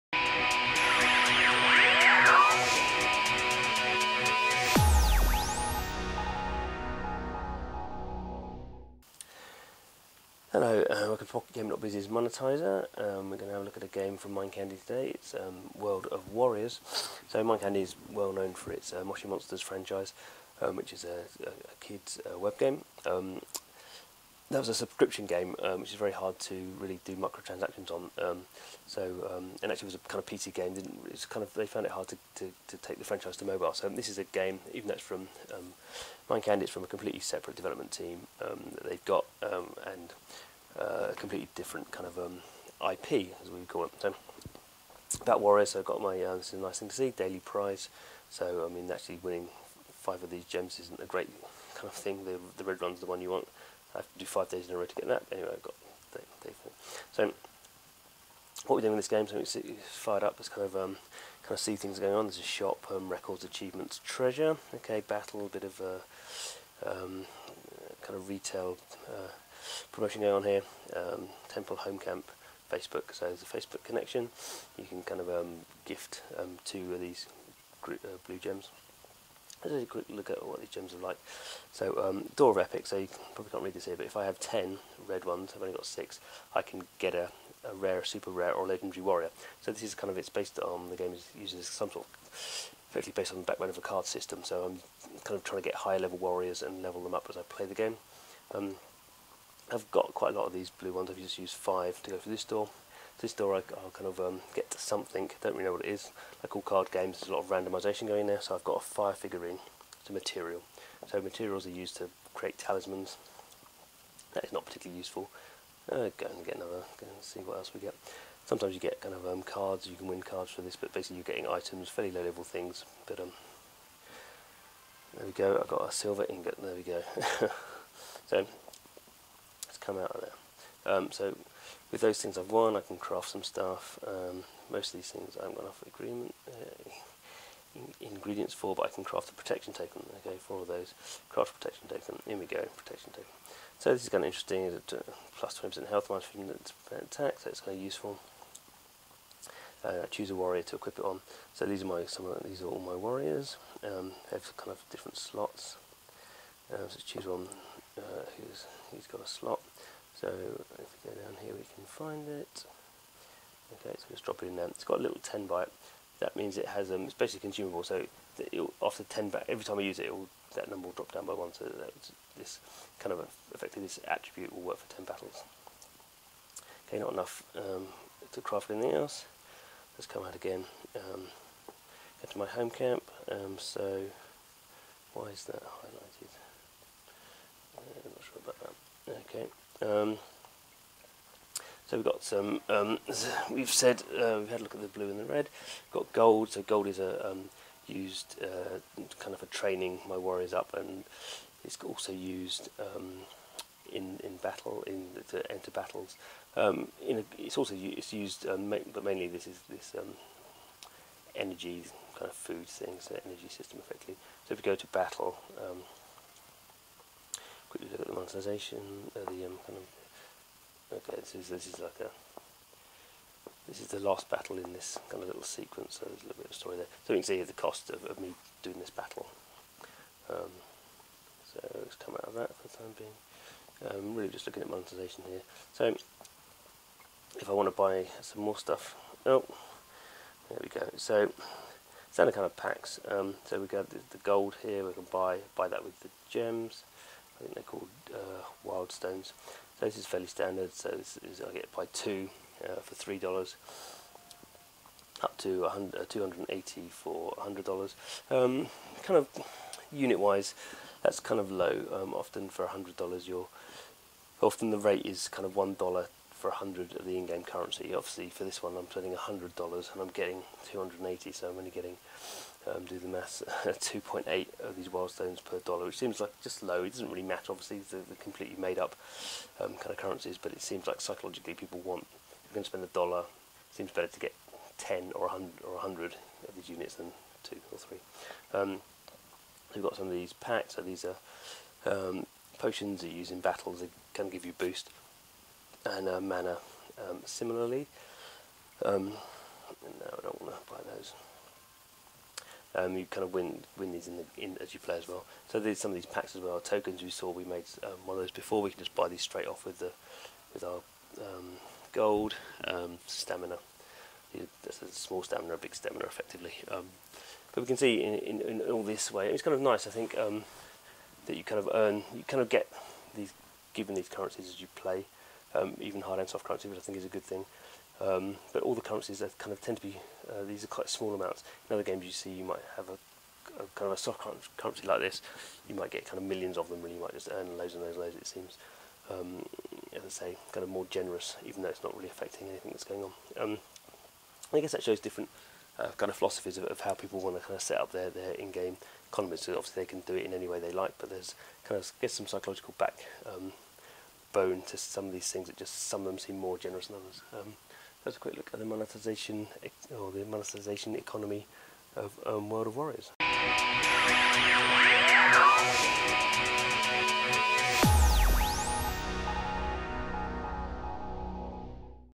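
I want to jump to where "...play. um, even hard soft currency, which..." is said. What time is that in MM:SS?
05:24.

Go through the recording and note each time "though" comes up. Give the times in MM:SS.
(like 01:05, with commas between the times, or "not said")
00:34, 05:41.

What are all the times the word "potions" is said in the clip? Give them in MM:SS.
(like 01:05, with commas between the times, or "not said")
04:52.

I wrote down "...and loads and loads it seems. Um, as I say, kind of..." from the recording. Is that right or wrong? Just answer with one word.
right.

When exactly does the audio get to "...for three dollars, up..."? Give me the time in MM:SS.
04:12.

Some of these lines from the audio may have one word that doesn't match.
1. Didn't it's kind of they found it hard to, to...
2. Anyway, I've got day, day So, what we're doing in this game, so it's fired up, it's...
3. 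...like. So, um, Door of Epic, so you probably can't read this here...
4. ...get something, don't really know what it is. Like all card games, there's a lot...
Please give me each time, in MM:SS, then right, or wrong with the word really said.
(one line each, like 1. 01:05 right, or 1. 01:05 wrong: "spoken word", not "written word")
1. 00:30 right
2. 00:55 right
3. 01:20 right
4. 01:44 right.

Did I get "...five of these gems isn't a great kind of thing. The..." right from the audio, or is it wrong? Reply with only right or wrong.
right.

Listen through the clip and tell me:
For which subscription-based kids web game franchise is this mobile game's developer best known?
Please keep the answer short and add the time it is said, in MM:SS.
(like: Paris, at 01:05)
Moshi Monsters, at 00:19.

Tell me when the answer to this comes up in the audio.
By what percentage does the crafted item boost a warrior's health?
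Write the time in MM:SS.
02:25.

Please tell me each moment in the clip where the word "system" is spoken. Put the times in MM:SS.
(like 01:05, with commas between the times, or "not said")
01:34, 03:33.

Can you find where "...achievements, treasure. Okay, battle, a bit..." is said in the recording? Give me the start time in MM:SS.
01:03.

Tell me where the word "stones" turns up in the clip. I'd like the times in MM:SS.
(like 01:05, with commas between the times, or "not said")
04:08, 04:35.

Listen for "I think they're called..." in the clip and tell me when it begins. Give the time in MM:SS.
04:07.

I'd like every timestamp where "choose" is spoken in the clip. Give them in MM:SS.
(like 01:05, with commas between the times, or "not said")
02:30, 02:37.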